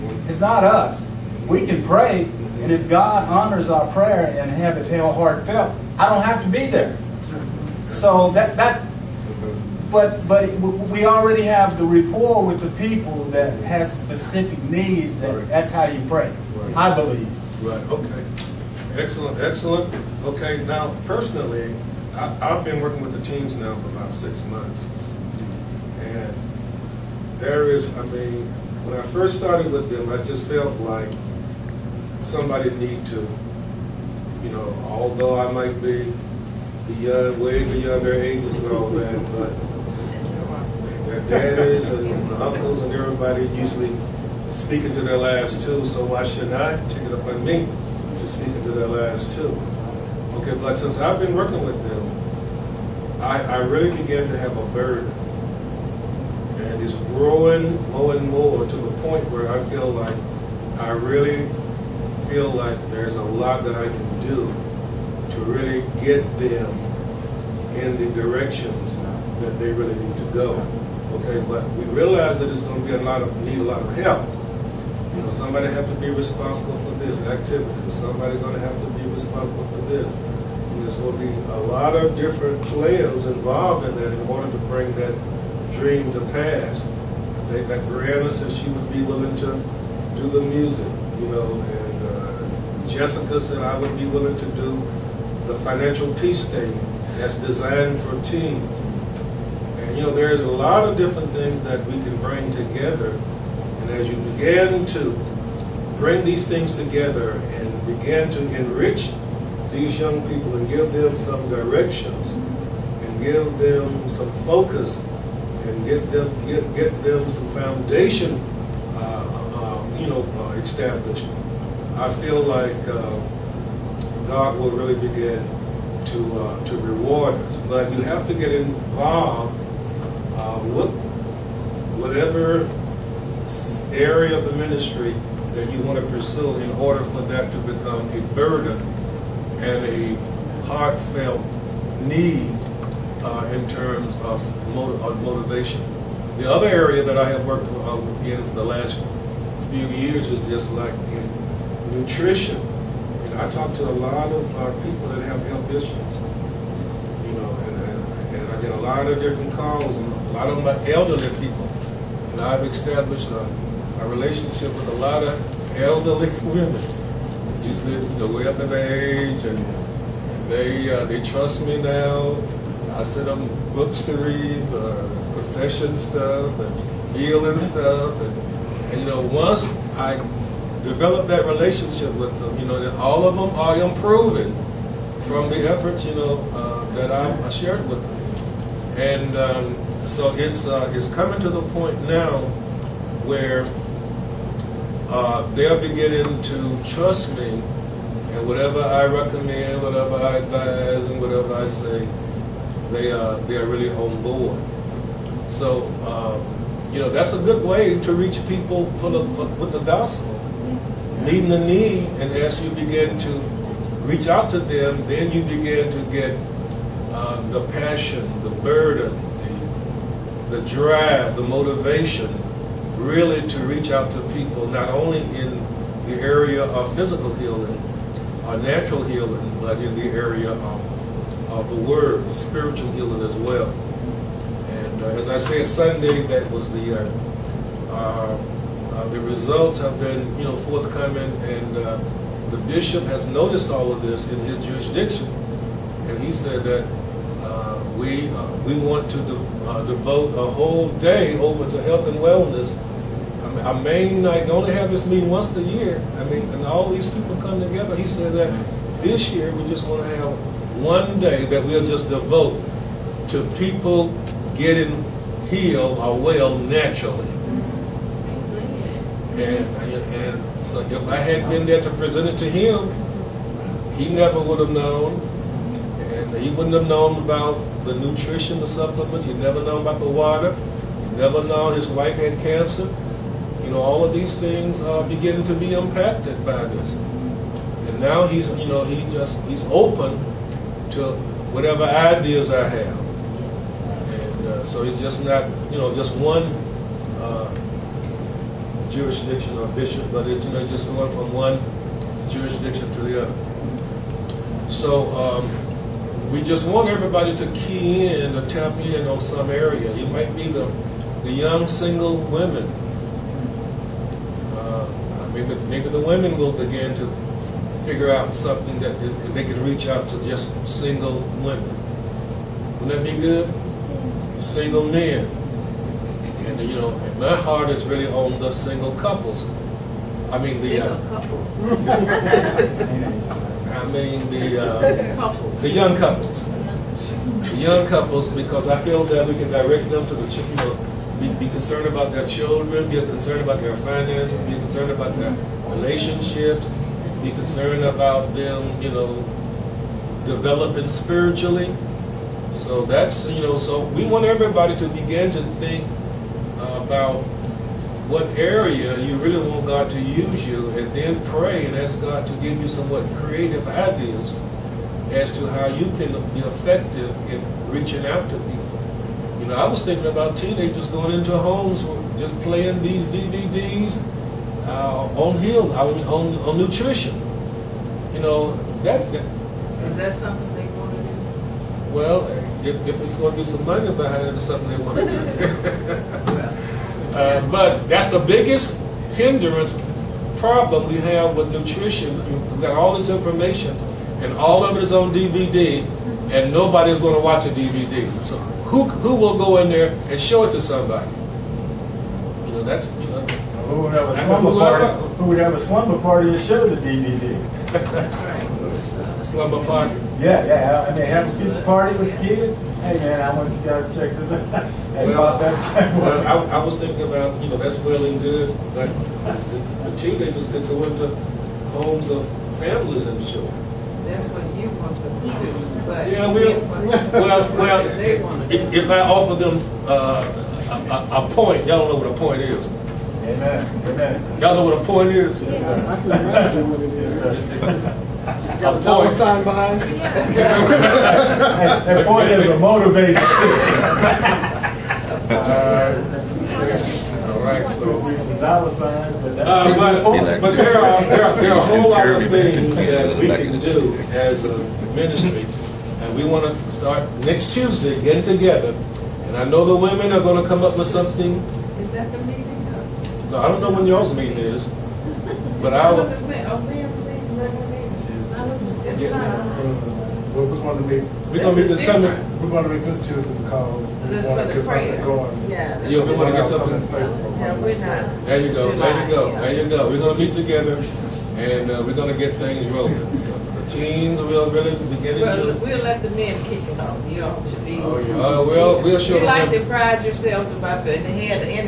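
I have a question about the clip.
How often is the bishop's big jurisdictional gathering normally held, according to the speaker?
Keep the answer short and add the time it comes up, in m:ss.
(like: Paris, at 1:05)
once a year, at 4:15.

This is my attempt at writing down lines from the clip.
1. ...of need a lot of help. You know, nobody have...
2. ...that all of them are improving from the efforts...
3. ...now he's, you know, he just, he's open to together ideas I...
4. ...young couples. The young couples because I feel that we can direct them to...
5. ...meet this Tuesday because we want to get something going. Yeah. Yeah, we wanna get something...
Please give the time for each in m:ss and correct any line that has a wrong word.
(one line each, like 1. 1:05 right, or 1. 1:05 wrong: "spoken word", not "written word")
1. 1:13 wrong: "somebody", not "nobody"
2. 3:02 right
3. 4:47 wrong: "whatever", not "together"
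4. 5:35 right
5. 7:52 right.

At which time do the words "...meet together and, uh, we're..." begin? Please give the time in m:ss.
8:00.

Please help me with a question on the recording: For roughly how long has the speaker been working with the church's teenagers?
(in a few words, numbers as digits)
6 months.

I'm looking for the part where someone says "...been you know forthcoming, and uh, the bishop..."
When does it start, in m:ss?
4:00.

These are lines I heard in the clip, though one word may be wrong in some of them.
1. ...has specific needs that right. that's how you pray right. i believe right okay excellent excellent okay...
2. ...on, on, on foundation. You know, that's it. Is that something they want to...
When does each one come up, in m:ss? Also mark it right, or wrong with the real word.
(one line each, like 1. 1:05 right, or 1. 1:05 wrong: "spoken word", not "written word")
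1. 0:13 right
2. 6:15 wrong: "nutrition", not "foundation".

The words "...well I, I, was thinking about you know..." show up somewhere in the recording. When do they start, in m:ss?
6:55.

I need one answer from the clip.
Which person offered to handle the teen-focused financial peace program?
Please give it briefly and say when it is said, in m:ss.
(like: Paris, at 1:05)
Jessica, at 1:32.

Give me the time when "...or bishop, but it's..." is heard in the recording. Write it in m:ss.
4:59.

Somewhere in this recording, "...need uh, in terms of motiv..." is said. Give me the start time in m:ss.
2:22.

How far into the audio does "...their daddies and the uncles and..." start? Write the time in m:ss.
0:41.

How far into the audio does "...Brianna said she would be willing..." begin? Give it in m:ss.
1:27.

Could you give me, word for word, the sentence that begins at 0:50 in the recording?
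Okay, but since I've been working with them, I, I really began to have a burden.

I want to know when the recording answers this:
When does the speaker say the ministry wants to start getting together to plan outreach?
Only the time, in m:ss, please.
7:37.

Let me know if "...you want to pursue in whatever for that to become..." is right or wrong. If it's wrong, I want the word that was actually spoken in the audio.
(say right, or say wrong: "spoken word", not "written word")
wrong: "order", not "whatever".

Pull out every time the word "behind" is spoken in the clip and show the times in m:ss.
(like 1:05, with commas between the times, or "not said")
6:23, 7:19.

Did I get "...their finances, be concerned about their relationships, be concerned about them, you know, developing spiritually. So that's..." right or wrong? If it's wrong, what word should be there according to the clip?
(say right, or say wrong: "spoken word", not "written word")
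right.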